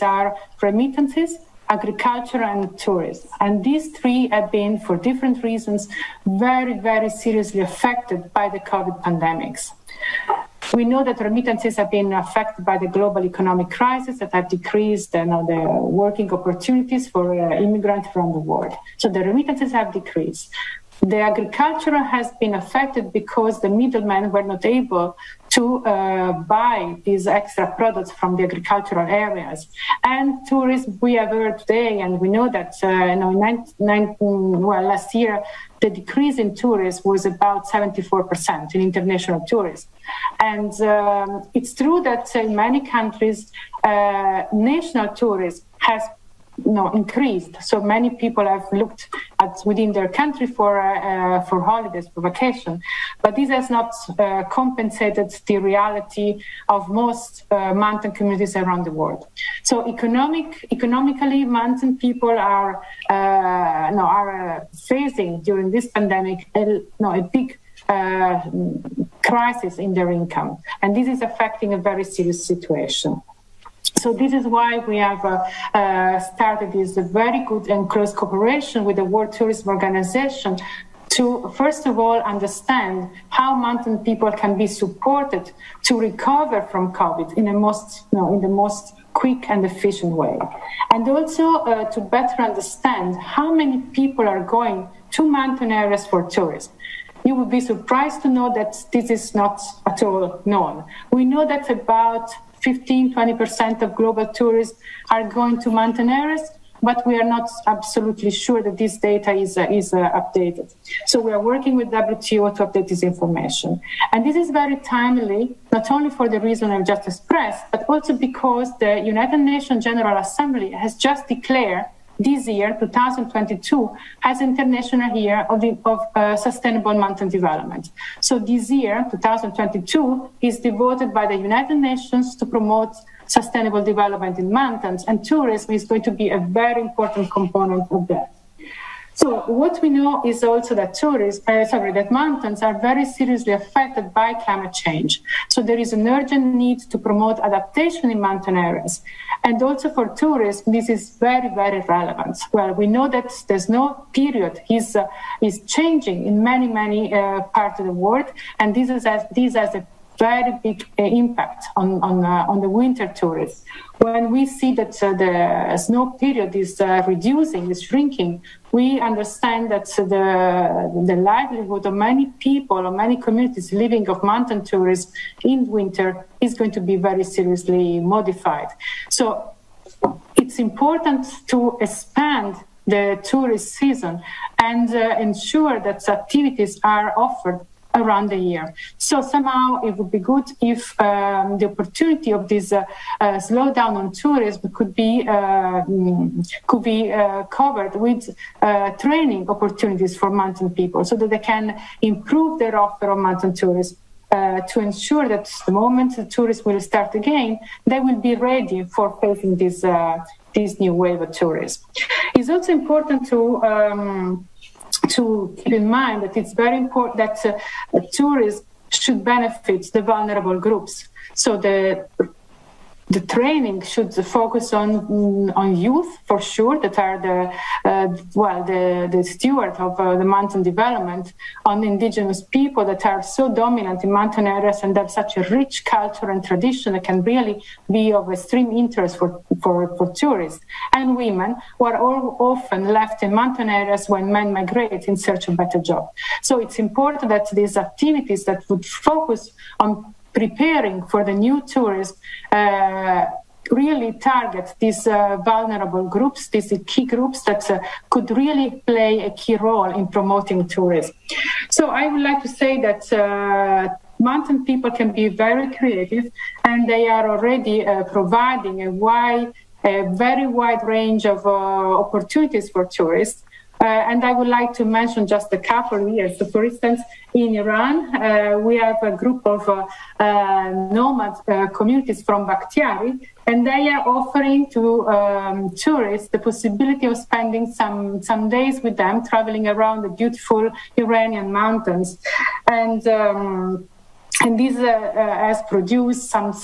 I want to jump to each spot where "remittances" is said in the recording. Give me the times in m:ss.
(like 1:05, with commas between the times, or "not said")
0:00, 0:11, 0:19.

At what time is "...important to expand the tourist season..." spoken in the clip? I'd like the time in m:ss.
3:00.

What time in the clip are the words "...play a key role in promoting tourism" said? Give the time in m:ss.
4:18.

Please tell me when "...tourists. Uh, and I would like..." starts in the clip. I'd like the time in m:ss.
4:32.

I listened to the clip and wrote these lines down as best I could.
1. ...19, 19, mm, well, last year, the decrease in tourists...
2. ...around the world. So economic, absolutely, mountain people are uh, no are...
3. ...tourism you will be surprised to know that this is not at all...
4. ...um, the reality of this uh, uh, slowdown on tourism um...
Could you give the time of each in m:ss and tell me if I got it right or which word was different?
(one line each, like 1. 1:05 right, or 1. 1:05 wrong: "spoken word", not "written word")
1. 0:33 right
2. 0:58 wrong: "economically", not "absolutely"
3. 1:36 right
4. 3:10 wrong: "opportunity", not "reality".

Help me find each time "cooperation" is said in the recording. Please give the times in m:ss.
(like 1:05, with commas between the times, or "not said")
1:18.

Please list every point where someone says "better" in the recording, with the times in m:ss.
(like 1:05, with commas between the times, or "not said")
1:32, 4:05.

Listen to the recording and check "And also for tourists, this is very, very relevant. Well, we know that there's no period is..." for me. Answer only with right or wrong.
right.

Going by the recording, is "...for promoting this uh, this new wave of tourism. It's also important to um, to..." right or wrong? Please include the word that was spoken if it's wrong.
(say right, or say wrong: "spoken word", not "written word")
wrong: "facing", not "promoting".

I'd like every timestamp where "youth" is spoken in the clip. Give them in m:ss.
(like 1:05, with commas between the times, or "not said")
3:45.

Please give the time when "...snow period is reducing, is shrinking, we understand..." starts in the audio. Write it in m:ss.
2:45.